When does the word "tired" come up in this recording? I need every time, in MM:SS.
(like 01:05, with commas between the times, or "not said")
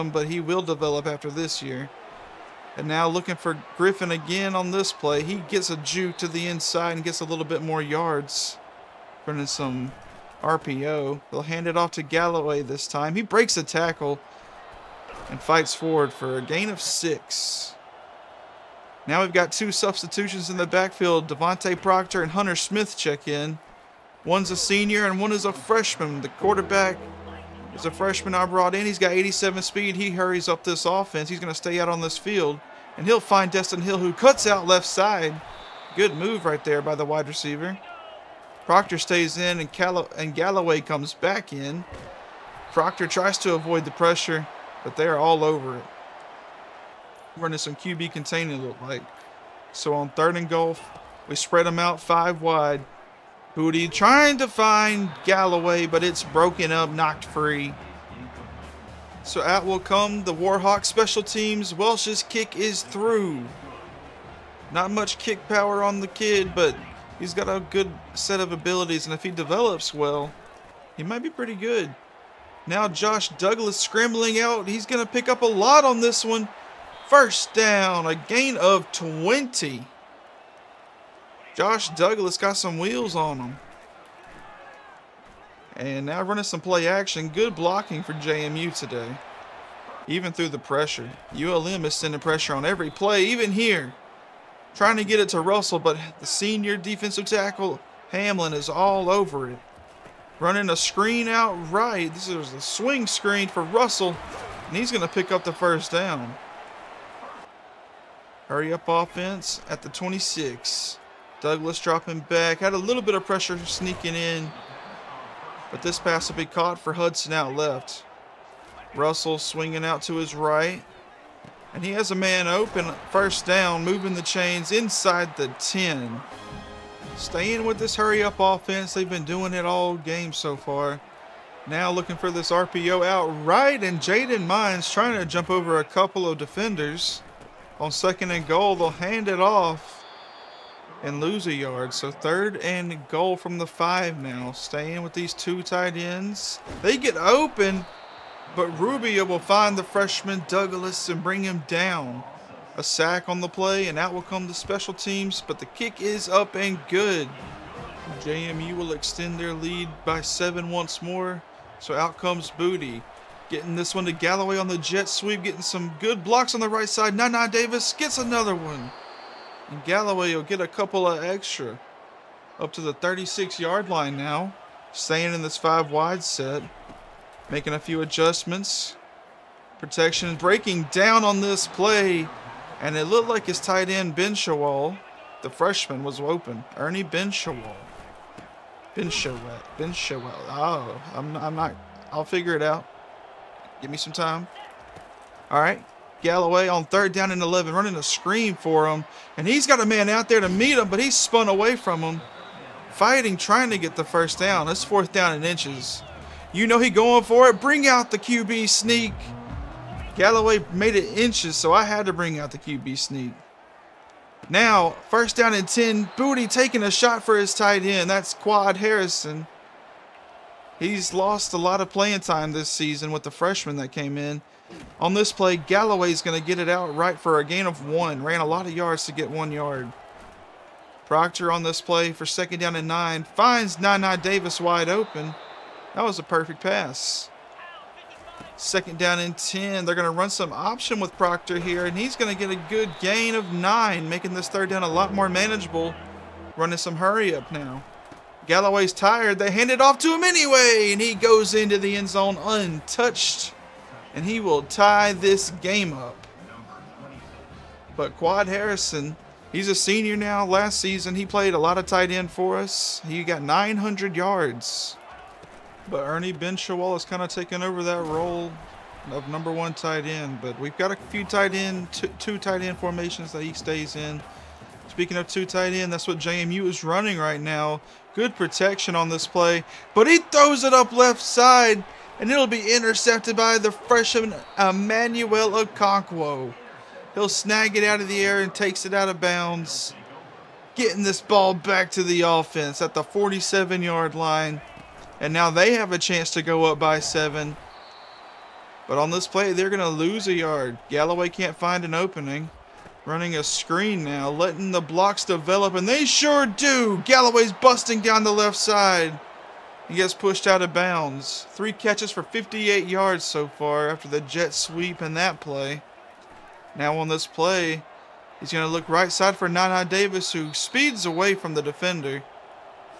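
04:08.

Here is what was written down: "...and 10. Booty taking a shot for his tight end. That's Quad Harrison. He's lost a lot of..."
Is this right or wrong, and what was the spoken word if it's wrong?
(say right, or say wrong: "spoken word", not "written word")
right.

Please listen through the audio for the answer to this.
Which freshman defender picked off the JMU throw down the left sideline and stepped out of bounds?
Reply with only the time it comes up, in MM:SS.
04:44.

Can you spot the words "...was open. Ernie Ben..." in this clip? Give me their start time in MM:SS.
03:06.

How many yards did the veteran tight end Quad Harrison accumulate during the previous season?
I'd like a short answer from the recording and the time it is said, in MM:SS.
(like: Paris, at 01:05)
900, at 04:23.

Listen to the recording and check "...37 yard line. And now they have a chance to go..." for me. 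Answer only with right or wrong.
wrong.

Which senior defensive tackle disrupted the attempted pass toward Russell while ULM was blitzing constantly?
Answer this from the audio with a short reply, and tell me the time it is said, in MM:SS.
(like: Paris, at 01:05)
Hamlin, at 01:38.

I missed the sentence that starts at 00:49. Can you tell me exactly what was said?
So on third and goal, we spread them out five wide.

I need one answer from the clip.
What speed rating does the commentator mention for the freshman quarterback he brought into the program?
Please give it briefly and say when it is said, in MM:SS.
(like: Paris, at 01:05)
87, at 00:29.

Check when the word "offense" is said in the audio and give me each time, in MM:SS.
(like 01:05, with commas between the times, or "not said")
00:30, 01:48, 02:08, 04:52.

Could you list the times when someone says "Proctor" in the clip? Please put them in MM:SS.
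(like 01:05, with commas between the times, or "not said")
00:21, 00:38, 00:42, 03:51, 04:01.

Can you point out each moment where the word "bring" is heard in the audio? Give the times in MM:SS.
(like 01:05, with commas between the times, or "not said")
02:31, 03:27, 03:32.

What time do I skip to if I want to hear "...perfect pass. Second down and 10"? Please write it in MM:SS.
03:56.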